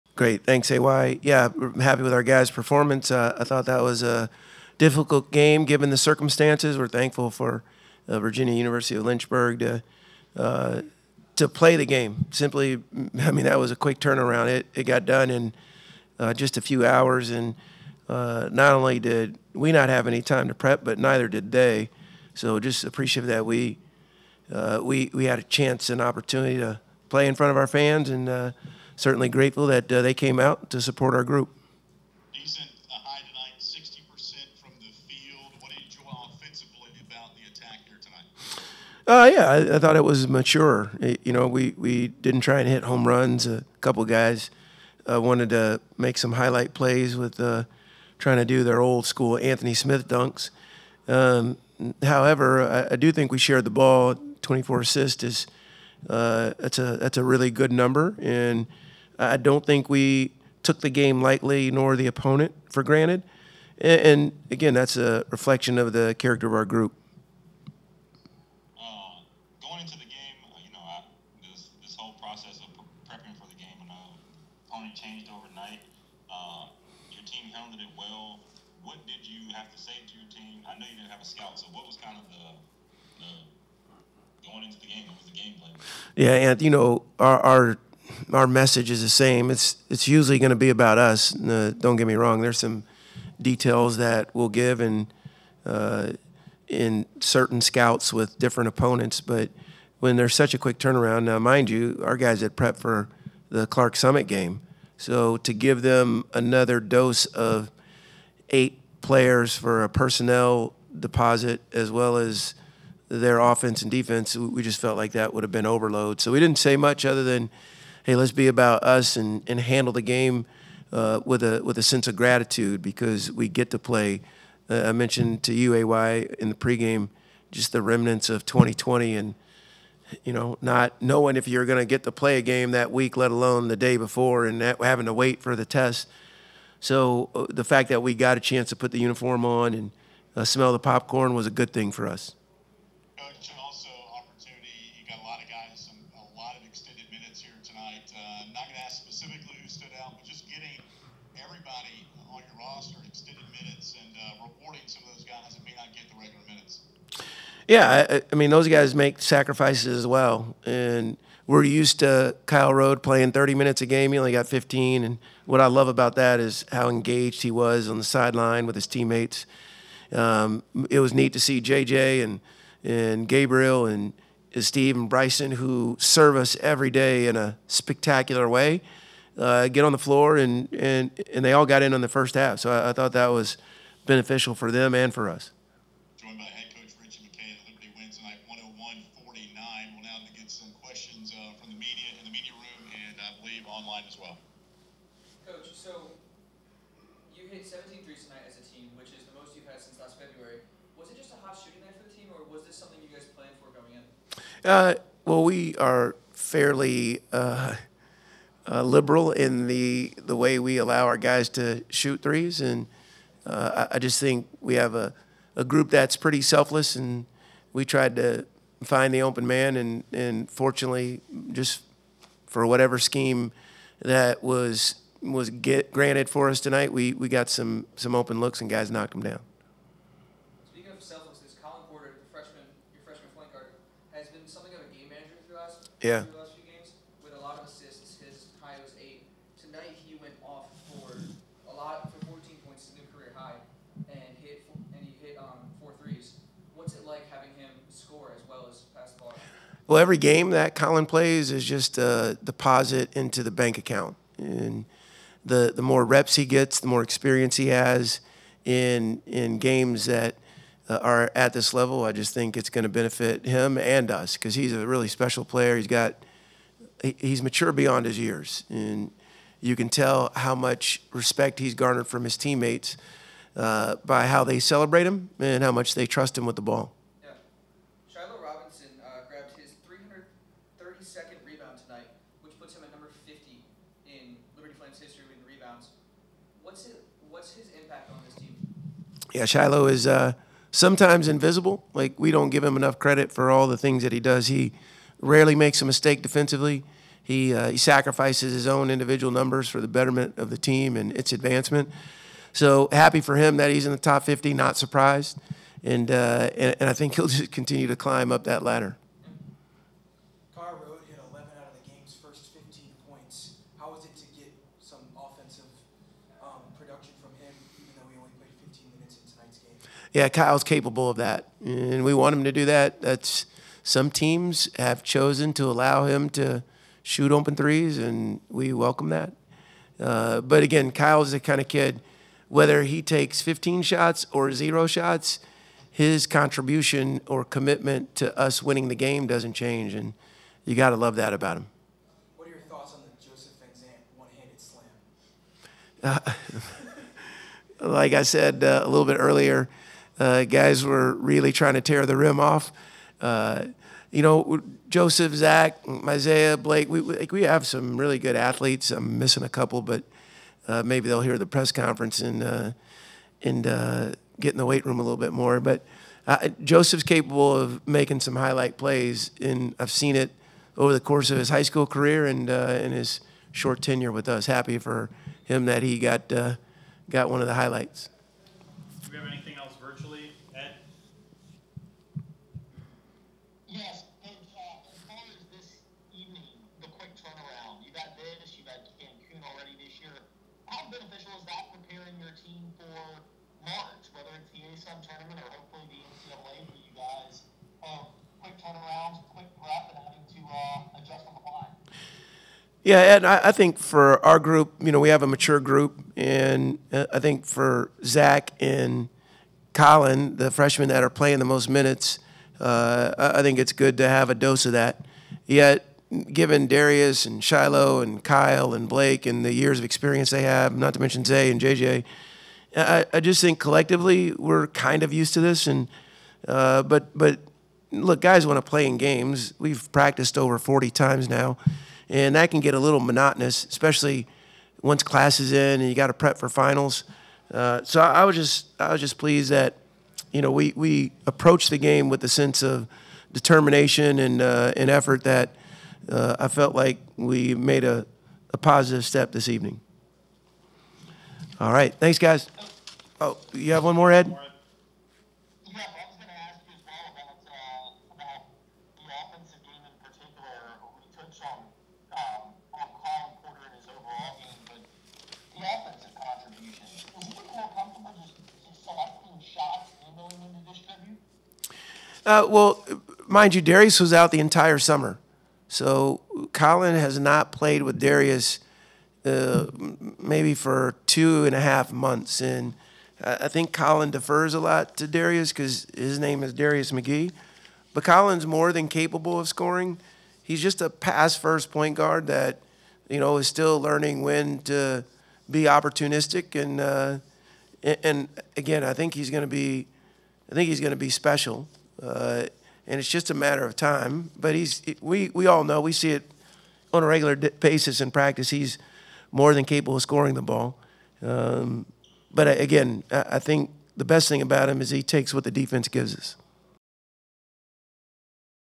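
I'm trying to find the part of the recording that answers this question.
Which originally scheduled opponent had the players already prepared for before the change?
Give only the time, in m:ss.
1:43.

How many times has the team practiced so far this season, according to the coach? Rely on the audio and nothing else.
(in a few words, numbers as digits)
over 40.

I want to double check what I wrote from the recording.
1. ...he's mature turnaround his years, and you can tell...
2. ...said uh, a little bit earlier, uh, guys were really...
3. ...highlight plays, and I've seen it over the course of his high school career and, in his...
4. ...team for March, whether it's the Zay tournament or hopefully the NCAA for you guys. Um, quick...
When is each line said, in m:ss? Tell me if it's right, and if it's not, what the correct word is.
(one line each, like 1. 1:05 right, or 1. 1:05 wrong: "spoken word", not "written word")
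1. 4:27 wrong: "beyond", not "turnaround"
2. 5:48 right
3. 6:08 right
4. 6:32 wrong: "ASUN", not "Zay".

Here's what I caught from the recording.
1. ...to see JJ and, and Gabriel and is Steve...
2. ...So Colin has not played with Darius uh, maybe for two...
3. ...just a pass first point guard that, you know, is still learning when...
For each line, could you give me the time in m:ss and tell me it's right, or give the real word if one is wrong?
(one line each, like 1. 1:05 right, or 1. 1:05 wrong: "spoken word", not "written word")
1. 2:51 right
2. 7:55 right
3. 8:10 right.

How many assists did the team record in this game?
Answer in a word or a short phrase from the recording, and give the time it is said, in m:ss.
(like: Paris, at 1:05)
24, at 0:54.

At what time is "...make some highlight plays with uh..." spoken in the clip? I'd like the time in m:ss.
0:45.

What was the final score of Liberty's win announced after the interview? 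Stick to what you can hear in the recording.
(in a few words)
101-49.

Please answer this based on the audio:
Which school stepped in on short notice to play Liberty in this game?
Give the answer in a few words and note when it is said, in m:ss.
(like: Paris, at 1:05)
Virginia University of Lynchburg, at 0:08.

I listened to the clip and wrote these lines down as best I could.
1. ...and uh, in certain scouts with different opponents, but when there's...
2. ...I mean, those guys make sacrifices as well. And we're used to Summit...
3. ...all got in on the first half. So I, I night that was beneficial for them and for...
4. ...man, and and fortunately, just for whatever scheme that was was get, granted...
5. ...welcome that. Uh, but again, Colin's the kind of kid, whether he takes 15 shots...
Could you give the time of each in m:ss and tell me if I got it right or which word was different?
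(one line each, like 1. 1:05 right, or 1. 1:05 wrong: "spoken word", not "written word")
1. 1:34 right
2. 2:38 wrong: "Kyle", not "Summit"
3. 3:01 wrong: "thought", not "night"
4. 3:39 right
5. 5:28 wrong: "Kyle", not "Colin".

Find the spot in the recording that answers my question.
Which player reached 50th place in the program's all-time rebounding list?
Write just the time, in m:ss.
4:38.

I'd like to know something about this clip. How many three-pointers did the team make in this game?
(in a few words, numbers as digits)
17.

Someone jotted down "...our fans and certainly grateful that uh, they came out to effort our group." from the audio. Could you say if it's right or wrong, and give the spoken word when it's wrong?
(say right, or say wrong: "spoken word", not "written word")
wrong: "support", not "effort".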